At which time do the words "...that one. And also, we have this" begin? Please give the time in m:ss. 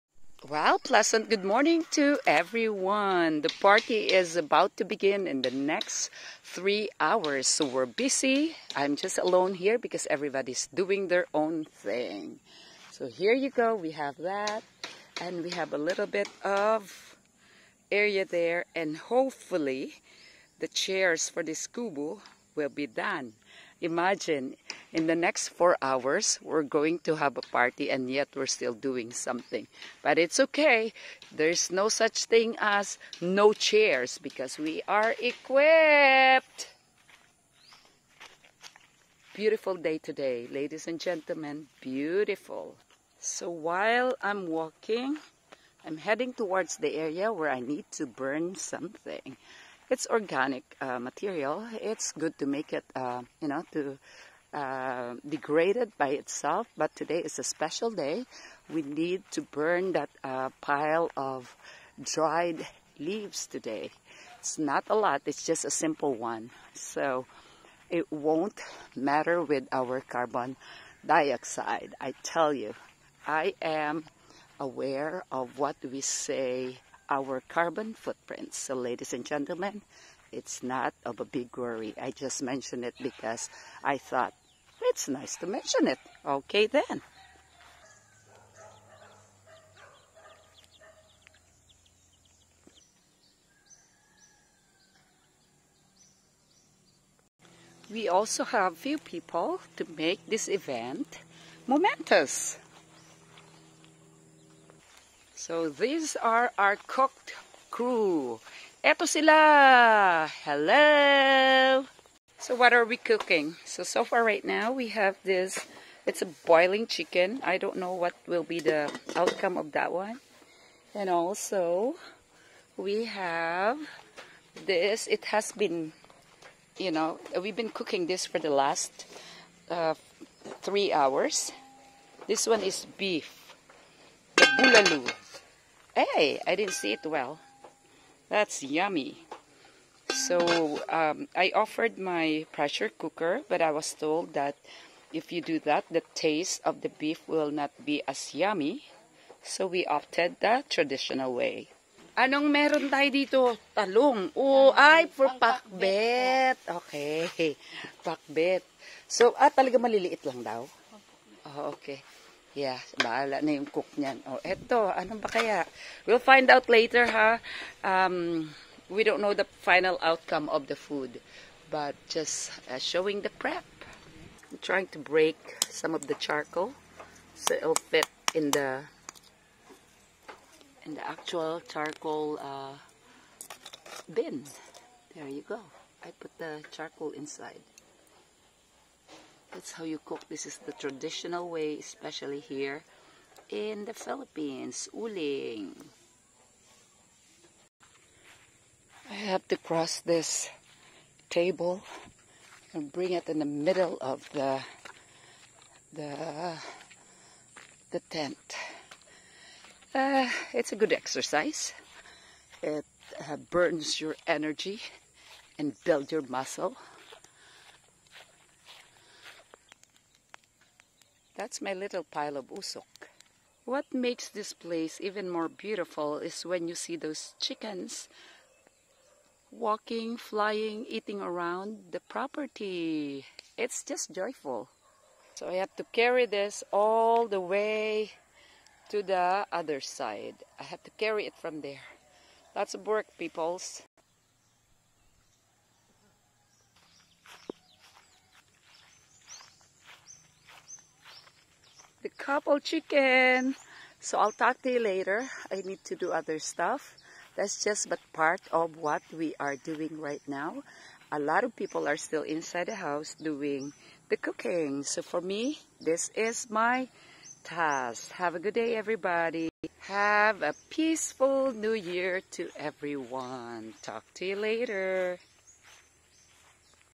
1:59.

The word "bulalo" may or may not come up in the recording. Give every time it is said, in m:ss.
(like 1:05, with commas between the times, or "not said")
2:14.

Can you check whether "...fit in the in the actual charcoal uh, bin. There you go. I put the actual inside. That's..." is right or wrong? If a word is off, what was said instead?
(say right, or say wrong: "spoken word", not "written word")
wrong: "charcoal", not "actual".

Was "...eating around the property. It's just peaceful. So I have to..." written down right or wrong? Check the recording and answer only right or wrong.
wrong.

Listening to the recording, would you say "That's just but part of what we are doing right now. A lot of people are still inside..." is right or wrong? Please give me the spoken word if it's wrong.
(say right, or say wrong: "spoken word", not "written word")
right.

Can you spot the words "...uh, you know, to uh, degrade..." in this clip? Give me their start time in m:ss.
0:52.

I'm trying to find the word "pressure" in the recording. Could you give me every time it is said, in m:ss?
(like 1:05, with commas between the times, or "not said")
2:22.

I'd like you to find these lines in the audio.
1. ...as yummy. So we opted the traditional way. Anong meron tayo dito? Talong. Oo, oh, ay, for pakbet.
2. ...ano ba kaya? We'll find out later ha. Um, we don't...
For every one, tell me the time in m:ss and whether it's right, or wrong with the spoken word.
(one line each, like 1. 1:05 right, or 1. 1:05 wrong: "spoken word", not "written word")
1. 2:28 right
2. 2:44 right.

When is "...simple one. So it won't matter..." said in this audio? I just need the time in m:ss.
1:05.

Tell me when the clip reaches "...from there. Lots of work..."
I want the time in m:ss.
4:01.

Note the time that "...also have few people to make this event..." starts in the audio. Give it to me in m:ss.
1:38.